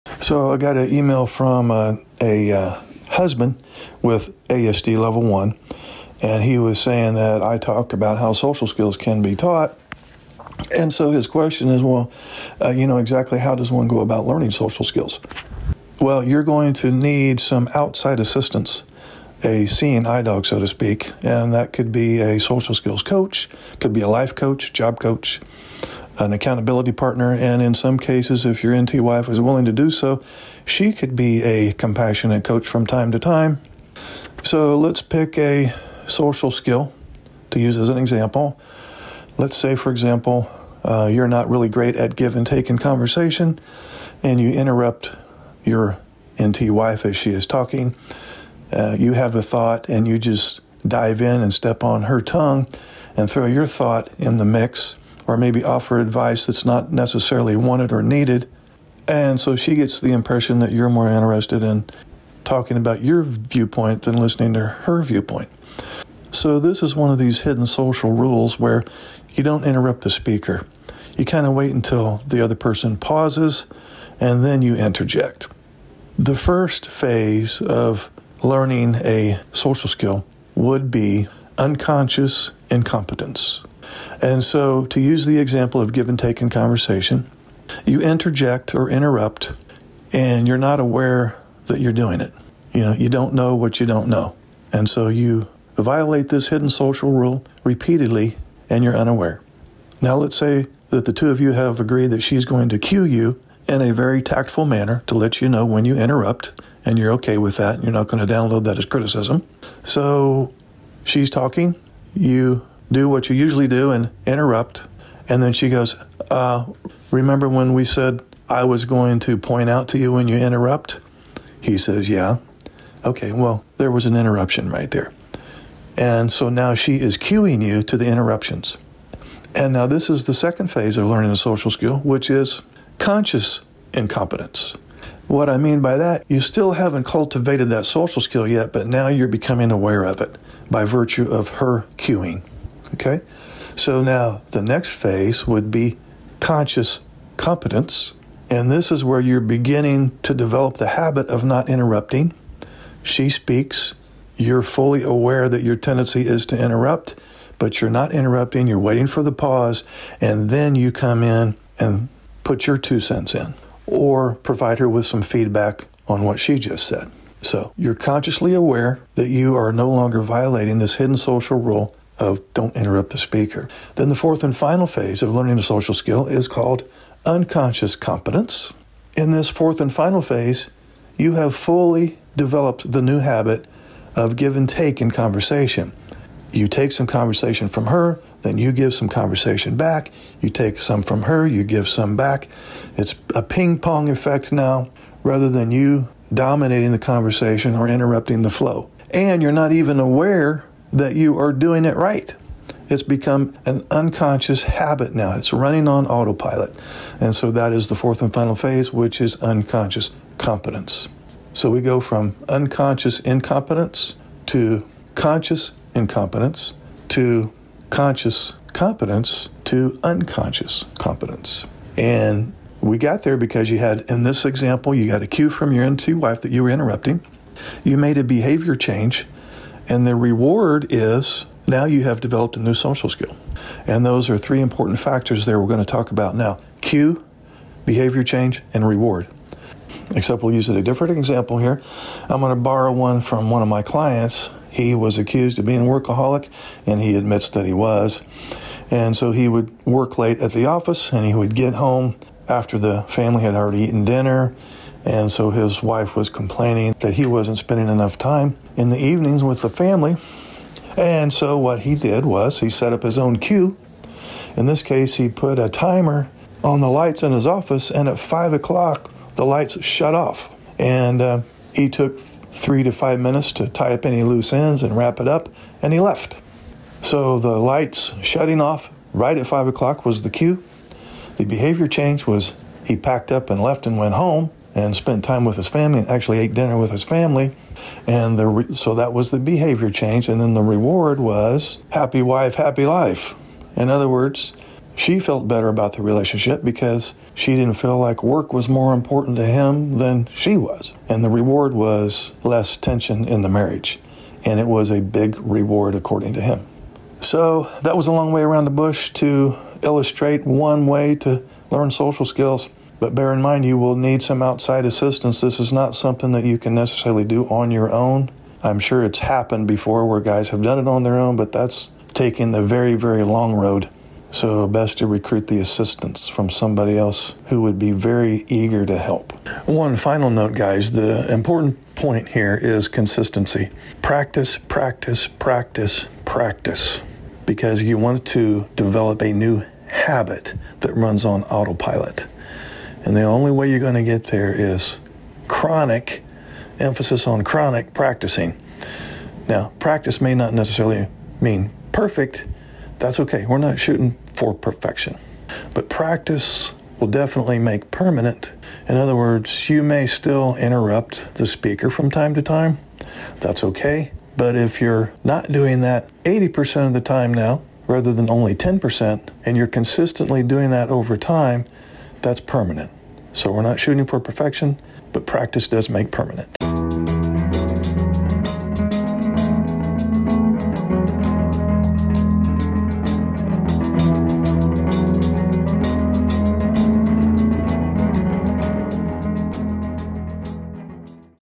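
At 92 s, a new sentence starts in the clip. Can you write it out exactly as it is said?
You know, you don't know what you don't know.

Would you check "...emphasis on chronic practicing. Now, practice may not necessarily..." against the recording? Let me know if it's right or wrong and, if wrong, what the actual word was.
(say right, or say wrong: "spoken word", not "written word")
right.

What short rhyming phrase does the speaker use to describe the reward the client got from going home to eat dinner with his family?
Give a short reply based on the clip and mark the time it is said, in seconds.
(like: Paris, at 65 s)
Happy wife, happy life, at 291 s.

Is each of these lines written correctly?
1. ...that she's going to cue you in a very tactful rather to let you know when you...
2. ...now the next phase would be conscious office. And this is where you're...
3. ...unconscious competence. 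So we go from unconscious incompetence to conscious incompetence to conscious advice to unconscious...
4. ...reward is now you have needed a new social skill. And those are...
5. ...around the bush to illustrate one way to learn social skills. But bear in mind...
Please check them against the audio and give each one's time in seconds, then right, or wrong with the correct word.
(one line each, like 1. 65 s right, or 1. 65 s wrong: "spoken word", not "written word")
1. 102 s wrong: "manner", not "rather"
2. 144 s wrong: "competence", not "office"
3. 209 s wrong: "competence", not "advice"
4. 230 s wrong: "developed", not "needed"
5. 308 s right.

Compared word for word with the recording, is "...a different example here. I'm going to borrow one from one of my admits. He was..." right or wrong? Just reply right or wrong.
wrong.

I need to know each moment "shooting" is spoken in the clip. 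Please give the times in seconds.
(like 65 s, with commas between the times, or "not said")
353 s, 373 s.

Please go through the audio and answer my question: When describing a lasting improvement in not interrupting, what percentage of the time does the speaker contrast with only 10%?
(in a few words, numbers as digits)
80%.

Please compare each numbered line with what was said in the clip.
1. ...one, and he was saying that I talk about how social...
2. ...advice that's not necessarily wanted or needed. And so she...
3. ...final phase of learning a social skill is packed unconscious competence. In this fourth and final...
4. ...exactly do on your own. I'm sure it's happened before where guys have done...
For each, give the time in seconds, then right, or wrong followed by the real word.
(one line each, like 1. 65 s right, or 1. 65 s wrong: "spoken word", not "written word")
1. 5 s right
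2. 55 s right
3. 174 s wrong: "called", not "packed"
4. 316 s wrong: "necessarily", not "exactly".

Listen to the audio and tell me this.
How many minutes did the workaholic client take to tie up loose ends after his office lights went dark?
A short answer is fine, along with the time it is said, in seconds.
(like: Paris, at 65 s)
3 to 5 minutes, at 272 s.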